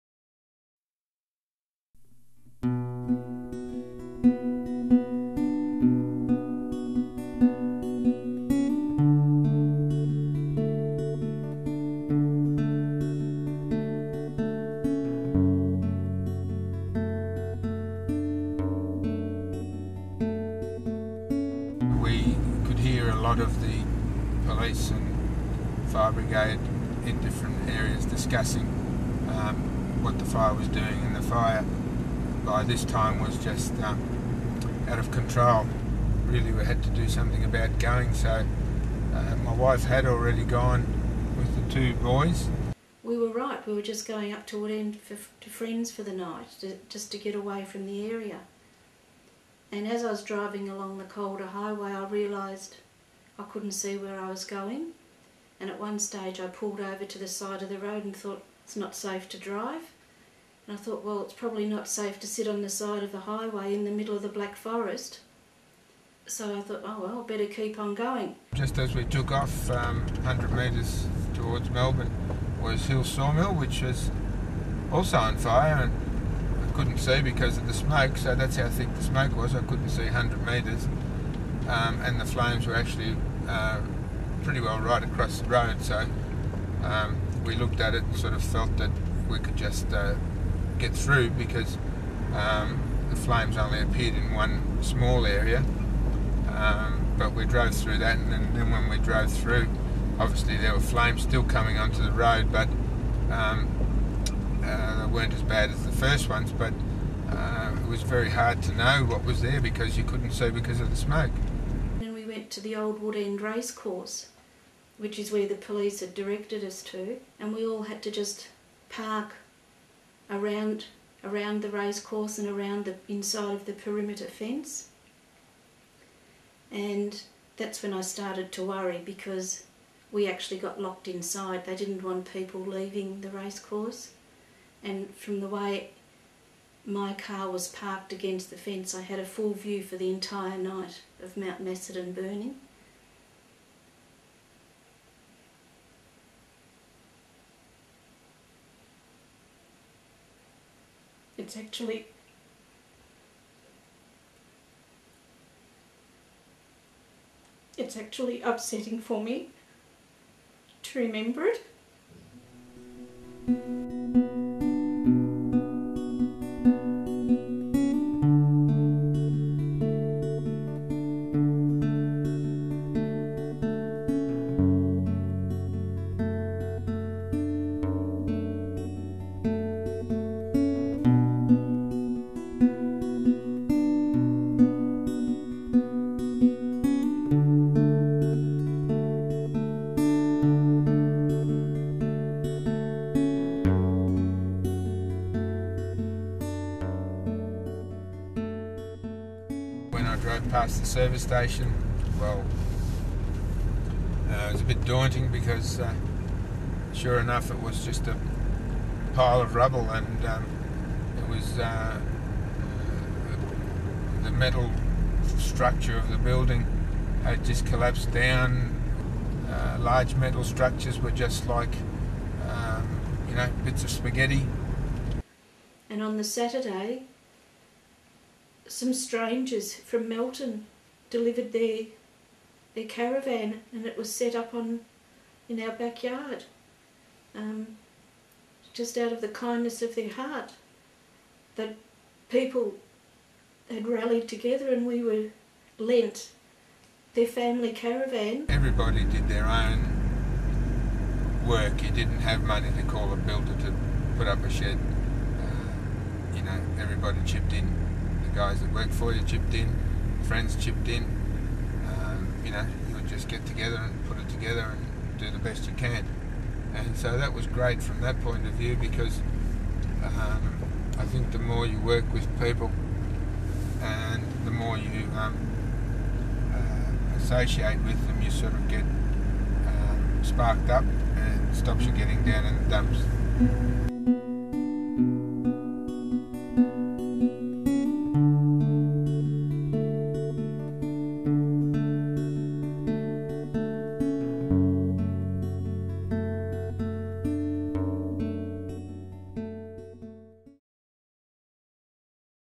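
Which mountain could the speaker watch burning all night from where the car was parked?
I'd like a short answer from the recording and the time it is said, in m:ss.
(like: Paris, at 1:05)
Mount Macedon, at 2:21.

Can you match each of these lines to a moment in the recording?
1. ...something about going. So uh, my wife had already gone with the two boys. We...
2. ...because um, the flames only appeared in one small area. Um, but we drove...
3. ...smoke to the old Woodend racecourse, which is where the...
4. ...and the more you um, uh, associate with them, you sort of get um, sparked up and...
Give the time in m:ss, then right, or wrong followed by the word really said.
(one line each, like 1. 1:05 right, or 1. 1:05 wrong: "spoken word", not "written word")
1. 0:37 right
2. 1:31 right
3. 1:50 right
4. 4:33 right.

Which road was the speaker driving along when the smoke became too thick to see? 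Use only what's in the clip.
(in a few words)
Calder Highway.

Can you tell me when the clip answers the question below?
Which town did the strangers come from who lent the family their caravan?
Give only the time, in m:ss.
3:50.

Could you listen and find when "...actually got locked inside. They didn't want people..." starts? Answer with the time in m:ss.
2:10.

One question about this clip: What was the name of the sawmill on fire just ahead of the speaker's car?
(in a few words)
Hill Sawmill.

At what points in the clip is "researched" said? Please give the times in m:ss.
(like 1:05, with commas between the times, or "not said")
not said.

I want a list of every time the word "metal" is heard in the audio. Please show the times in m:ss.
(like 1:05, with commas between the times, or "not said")
3:34, 3:40.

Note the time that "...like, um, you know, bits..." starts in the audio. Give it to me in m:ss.
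3:41.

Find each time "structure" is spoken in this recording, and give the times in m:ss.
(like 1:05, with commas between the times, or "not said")
3:35, 3:40.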